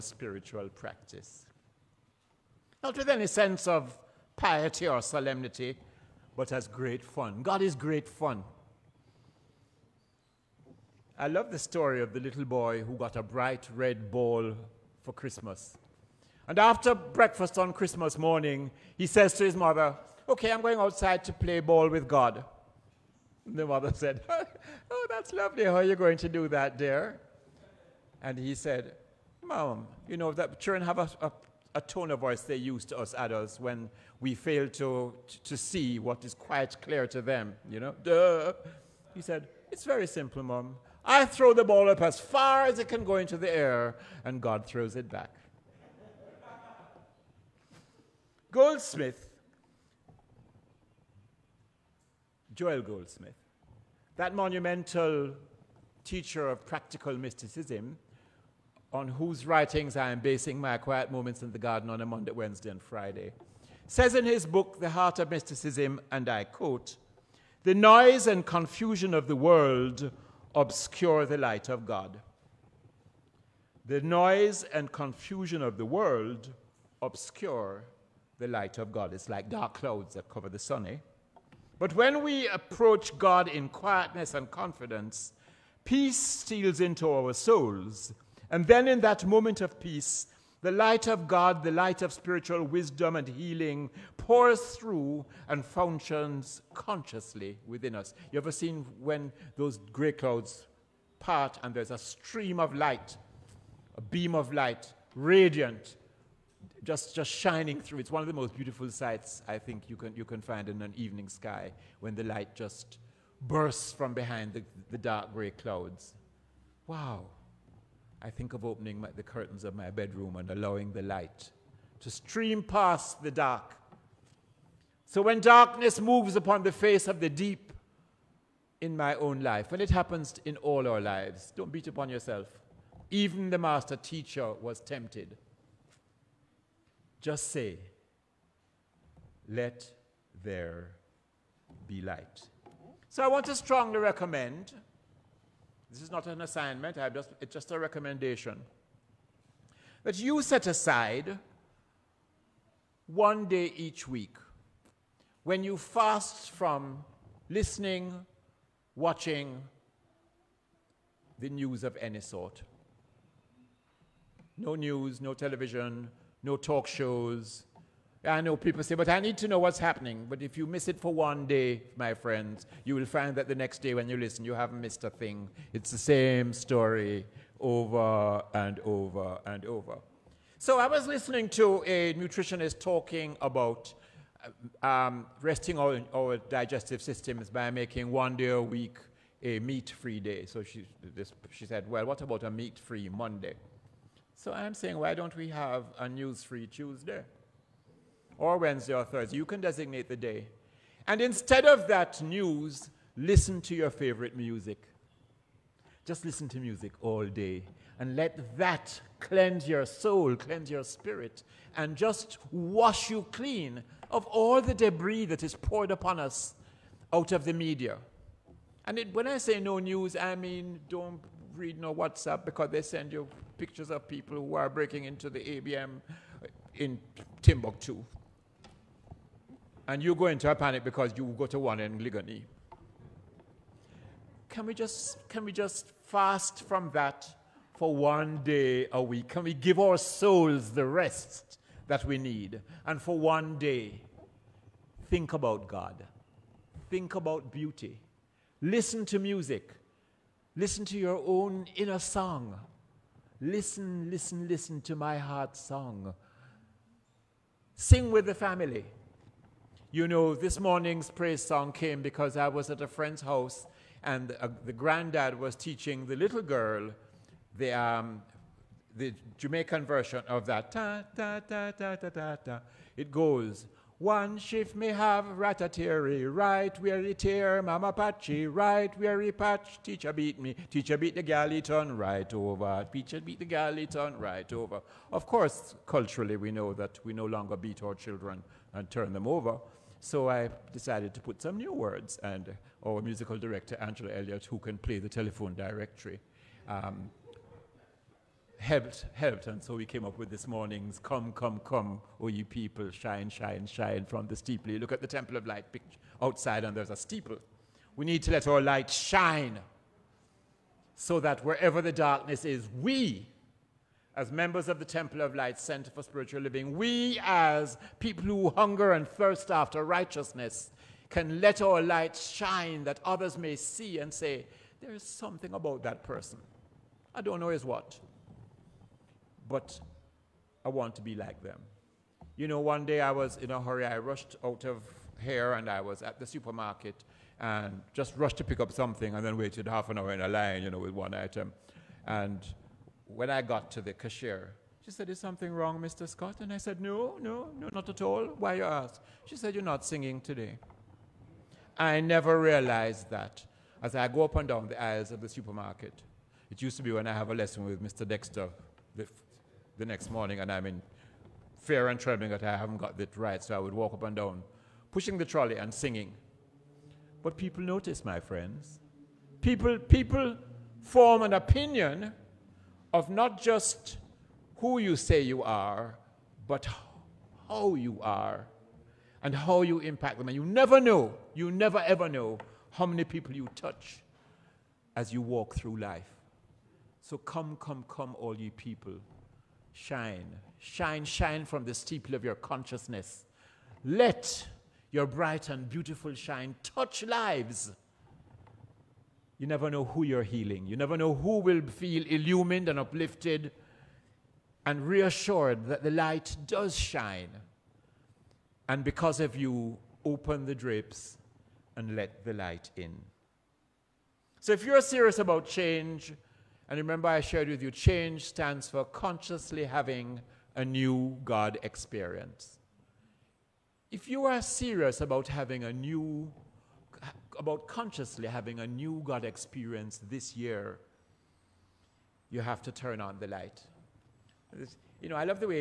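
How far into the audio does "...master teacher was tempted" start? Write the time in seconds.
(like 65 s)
133 s.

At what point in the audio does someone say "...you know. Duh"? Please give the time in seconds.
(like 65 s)
37 s.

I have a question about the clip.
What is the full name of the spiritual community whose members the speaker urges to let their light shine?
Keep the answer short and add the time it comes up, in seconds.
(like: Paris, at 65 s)
Temple of Light Center for Spiritual Living, at 314 s.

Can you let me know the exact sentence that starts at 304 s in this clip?
You look at the Temple of Light picture outside, and there's a steeple.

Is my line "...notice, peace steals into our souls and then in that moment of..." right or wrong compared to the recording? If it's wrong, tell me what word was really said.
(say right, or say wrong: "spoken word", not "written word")
wrong: "confidence", not "notice".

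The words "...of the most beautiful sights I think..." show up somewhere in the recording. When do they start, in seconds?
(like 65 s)
108 s.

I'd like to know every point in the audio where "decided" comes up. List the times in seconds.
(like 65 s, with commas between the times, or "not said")
290 s.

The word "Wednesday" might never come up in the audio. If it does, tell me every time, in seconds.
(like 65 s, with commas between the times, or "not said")
62 s, 198 s.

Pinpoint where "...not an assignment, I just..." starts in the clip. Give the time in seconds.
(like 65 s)
146 s.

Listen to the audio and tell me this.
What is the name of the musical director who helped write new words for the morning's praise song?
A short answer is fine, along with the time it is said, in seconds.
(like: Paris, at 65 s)
Angela Elliott, at 293 s.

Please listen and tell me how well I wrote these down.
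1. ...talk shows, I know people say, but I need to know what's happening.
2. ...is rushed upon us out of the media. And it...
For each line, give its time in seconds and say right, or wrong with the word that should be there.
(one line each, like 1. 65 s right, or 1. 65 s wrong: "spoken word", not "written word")
1. 166 s right
2. 215 s wrong: "poured", not "rushed".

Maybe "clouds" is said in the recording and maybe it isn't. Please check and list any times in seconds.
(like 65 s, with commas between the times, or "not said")
79 s, 100 s, 115 s.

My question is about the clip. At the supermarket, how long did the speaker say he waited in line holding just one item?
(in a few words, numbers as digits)
half an hour.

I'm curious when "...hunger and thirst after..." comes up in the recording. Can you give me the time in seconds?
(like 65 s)
318 s.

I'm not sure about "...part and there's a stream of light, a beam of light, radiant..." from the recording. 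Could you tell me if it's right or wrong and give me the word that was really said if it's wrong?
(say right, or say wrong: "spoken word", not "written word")
right.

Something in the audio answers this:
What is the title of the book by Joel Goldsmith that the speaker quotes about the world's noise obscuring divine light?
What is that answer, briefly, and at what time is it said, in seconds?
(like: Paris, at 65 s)
The Heart of Mysticism, at 64 s.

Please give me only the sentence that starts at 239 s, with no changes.
Can we give our souls the rest that we need?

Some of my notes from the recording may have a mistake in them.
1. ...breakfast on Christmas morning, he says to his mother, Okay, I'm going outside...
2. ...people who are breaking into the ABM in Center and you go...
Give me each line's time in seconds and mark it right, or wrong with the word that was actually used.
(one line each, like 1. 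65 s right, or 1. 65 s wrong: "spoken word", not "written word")
1. 16 s right
2. 224 s wrong: "Timbuktu", not "Center".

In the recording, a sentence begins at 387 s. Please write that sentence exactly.
So come, come, come, all ye people.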